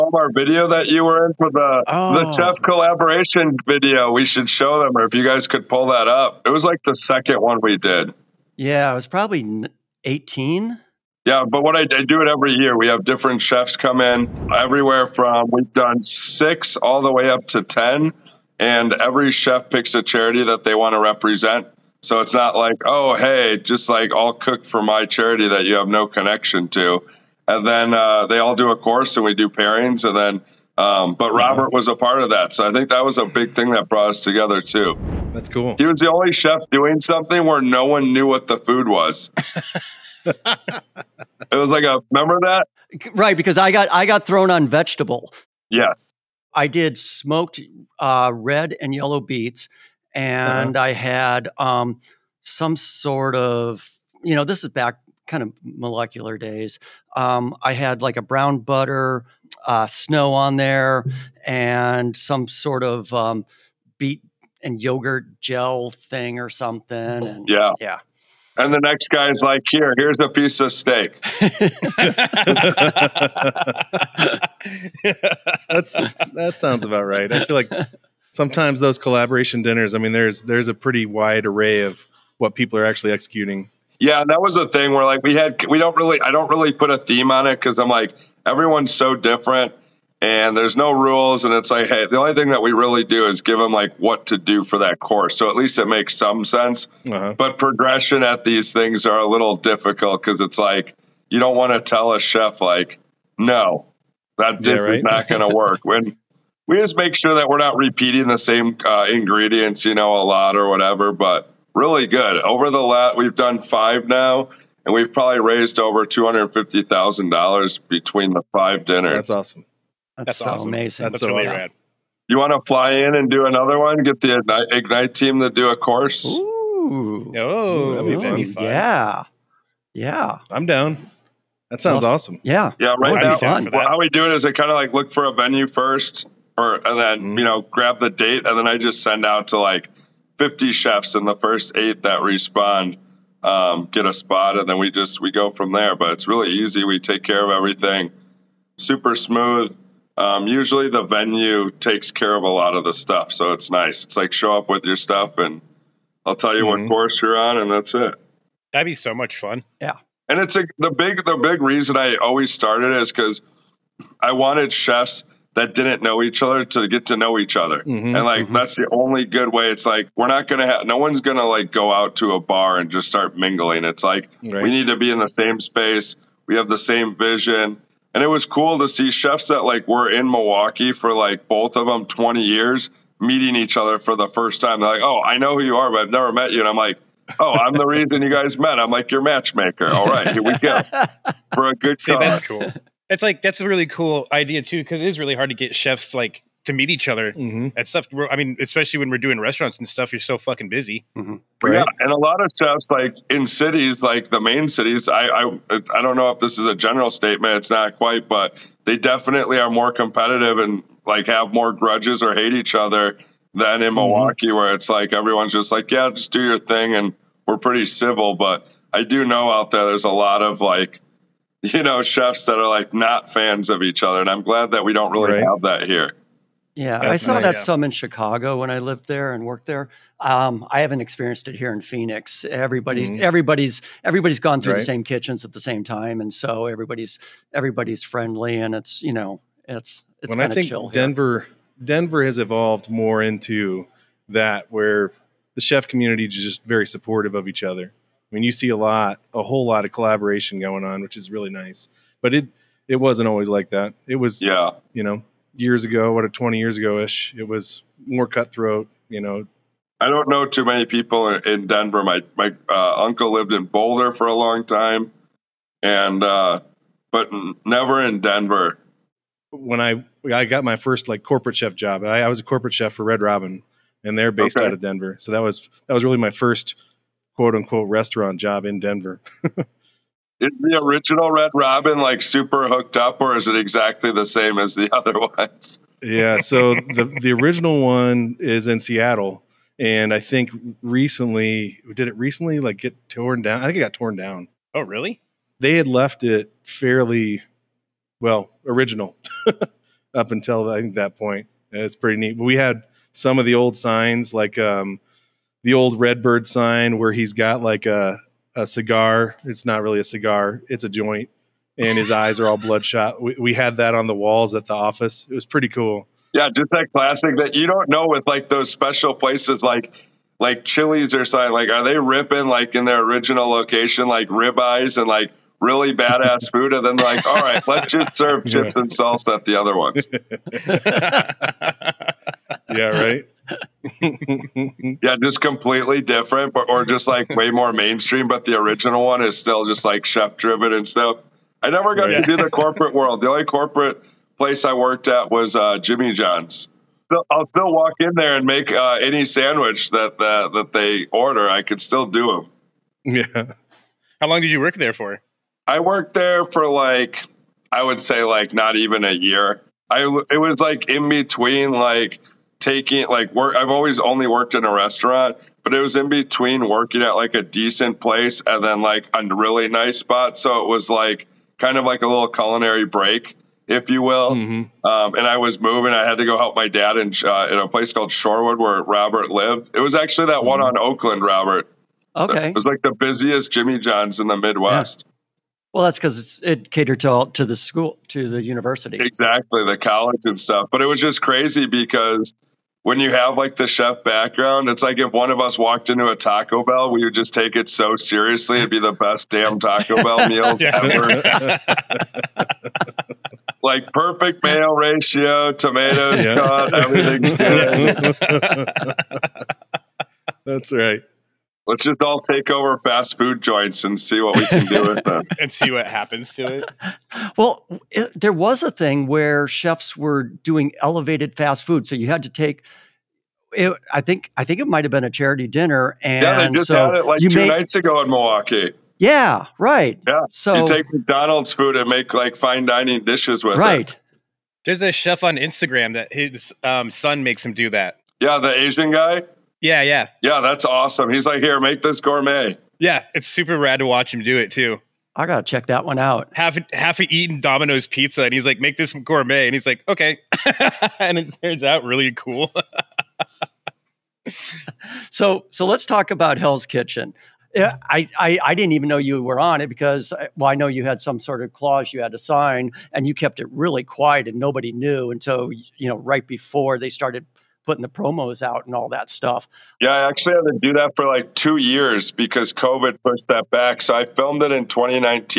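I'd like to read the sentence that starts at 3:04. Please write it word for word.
They're like, oh, I know who you are, but I've never met you.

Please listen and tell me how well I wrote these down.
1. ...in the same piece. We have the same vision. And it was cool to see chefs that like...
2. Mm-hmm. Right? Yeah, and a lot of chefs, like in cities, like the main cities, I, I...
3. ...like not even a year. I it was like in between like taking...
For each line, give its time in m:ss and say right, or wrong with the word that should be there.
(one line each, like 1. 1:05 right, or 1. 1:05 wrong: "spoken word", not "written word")
1. 2:55 wrong: "space", not "piece"
2. 3:21 right
3. 5:58 right.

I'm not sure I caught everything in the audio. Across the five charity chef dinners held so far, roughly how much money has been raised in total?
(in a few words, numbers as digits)
$250,000.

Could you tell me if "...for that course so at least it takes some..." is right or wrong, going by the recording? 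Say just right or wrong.
wrong.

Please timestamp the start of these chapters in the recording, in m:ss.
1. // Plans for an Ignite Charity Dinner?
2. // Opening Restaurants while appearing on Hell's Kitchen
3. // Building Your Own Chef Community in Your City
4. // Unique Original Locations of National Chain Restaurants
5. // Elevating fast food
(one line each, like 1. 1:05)
1. 2:01
2. 7:33
3. 2:39
4. 4:39
5. 6:50.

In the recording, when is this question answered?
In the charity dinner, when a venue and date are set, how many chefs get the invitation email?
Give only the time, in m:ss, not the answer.
2:20.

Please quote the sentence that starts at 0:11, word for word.
Yeah, but what I, I do it every year.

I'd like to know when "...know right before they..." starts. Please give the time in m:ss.
7:45.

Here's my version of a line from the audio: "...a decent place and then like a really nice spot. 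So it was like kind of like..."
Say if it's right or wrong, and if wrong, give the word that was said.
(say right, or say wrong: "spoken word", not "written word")
right.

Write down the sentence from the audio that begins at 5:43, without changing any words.
The only corporate place I worked at was uh, Jimmy John's.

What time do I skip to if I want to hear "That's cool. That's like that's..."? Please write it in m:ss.
3:12.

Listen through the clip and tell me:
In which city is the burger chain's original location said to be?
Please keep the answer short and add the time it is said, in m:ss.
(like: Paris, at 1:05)
Seattle, at 4:48.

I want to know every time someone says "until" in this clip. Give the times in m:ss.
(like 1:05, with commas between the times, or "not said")
5:00, 7:45.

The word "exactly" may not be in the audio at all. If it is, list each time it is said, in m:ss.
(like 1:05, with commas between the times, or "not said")
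4:43, 6:28.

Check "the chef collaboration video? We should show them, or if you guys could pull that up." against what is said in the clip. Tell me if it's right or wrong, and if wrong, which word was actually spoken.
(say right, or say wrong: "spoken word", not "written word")
right.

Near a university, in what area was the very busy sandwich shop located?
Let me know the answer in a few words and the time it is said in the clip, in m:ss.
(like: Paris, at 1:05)
Shorewood, at 6:18.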